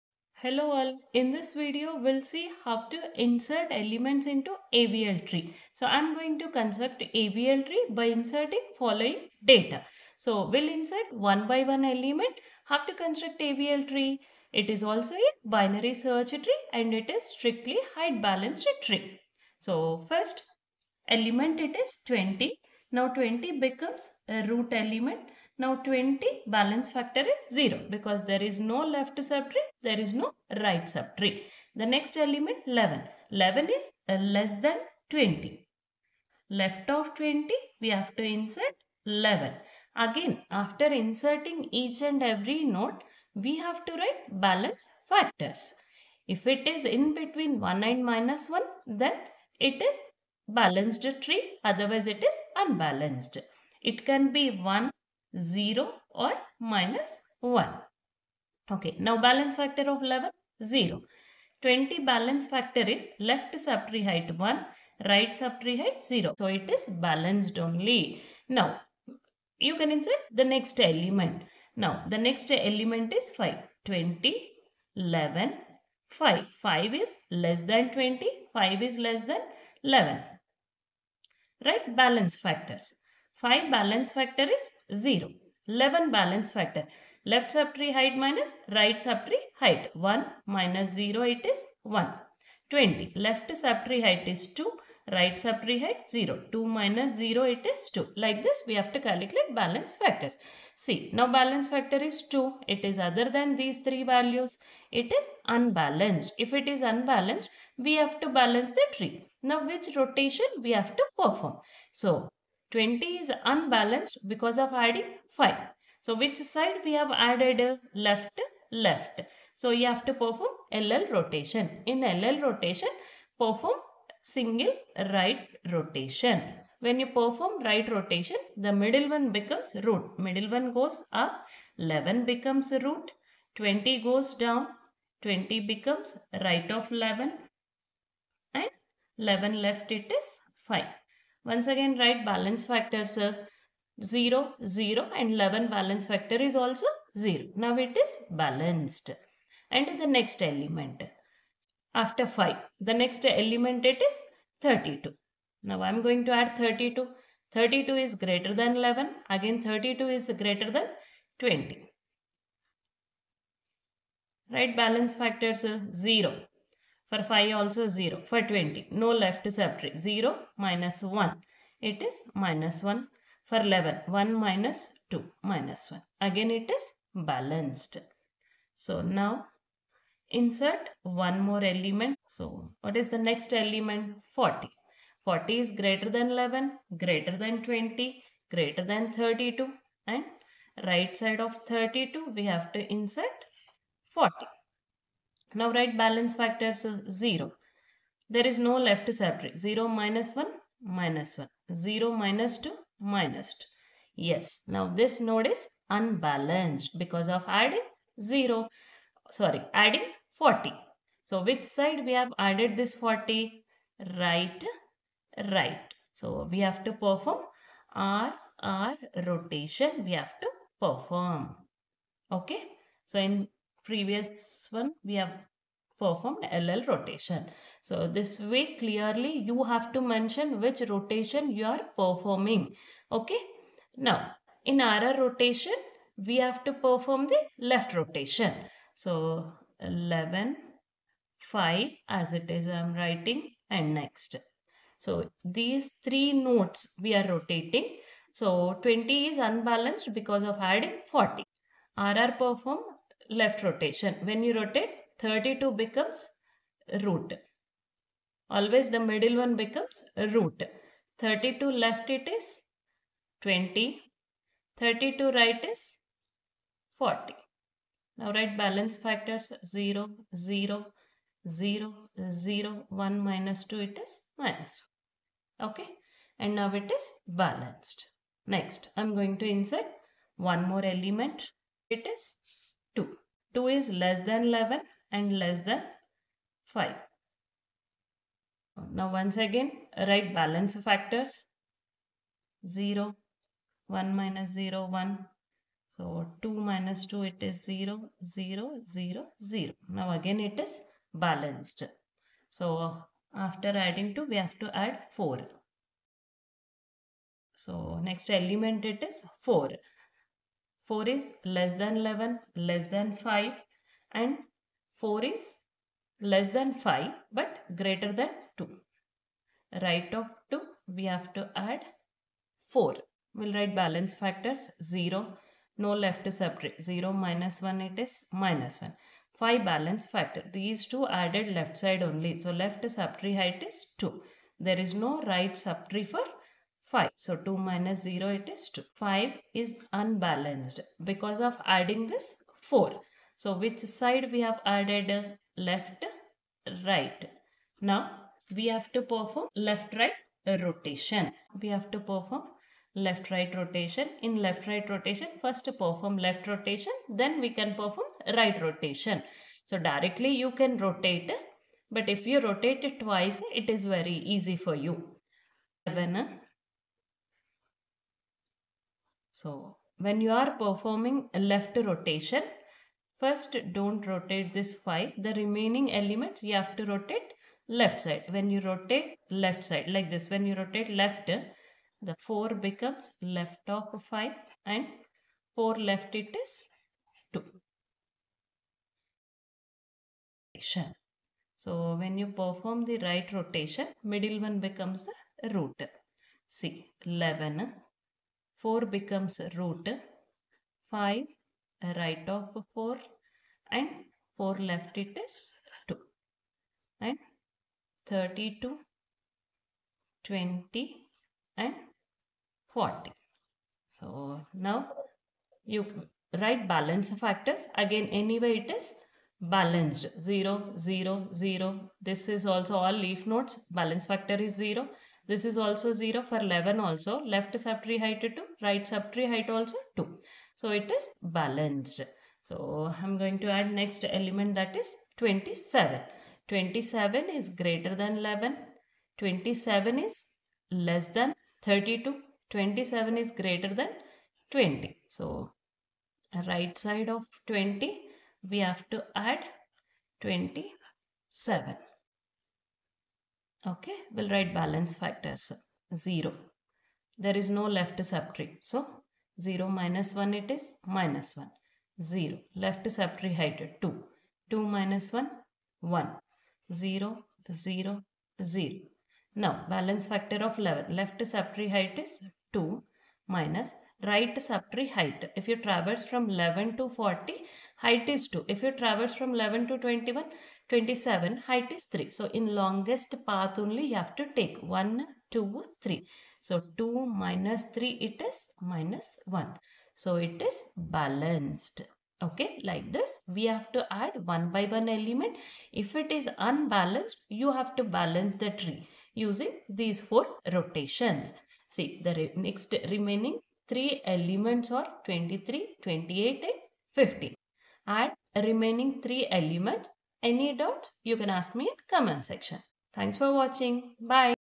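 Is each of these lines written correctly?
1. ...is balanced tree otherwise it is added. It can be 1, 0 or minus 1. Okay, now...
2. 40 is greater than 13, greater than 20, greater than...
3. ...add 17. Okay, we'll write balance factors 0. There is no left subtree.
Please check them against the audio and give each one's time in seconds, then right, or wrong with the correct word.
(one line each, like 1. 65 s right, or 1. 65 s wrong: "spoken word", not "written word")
1. 49 s wrong: "unbalanced", not "added"
2. 185 s wrong: "11", not "13"
3. 449 s wrong: "27", not "17".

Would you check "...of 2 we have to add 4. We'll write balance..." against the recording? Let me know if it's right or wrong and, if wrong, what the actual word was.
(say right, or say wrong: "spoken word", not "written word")
right.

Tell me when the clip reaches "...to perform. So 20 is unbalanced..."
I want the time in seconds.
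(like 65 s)
110 s.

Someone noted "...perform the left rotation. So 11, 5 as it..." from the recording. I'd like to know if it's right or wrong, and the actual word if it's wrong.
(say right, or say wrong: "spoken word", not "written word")
right.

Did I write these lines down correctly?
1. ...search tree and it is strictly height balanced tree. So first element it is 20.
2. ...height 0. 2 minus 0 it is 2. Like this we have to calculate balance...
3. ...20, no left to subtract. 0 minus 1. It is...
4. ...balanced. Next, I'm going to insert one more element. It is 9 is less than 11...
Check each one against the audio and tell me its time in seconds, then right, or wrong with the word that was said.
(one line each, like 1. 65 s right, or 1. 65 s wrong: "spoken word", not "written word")
1. 15 s right
2. 95 s right
3. 168 s right
4. 277 s wrong: "2", not "9".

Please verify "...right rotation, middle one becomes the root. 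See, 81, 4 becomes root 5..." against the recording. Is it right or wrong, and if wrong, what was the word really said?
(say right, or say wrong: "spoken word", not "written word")
wrong: "11", not "81".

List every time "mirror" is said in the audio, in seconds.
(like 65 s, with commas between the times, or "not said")
not said.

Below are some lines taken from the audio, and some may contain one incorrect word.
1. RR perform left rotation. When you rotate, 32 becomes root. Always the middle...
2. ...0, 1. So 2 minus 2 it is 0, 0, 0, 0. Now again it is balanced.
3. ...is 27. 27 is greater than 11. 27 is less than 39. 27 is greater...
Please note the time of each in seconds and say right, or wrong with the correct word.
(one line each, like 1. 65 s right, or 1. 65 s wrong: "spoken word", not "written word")
1. 251 s right
2. 294 s right
3. 434 s wrong: "32", not "39".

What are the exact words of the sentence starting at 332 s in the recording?
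So left subtree height is 2.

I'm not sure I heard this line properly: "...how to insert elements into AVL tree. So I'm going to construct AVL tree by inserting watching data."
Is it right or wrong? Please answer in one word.
wrong.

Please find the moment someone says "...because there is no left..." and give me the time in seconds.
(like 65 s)
27 s.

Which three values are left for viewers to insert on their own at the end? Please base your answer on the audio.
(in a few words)
23, 28 and 50.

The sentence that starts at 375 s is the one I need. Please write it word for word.
The remaining elements you have to rotate left side.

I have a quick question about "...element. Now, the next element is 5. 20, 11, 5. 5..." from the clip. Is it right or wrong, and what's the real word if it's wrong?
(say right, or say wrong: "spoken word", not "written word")
right.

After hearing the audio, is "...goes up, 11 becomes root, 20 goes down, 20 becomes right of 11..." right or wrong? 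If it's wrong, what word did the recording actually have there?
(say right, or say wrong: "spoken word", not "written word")
right.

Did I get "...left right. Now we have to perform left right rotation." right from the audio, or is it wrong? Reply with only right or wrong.
right.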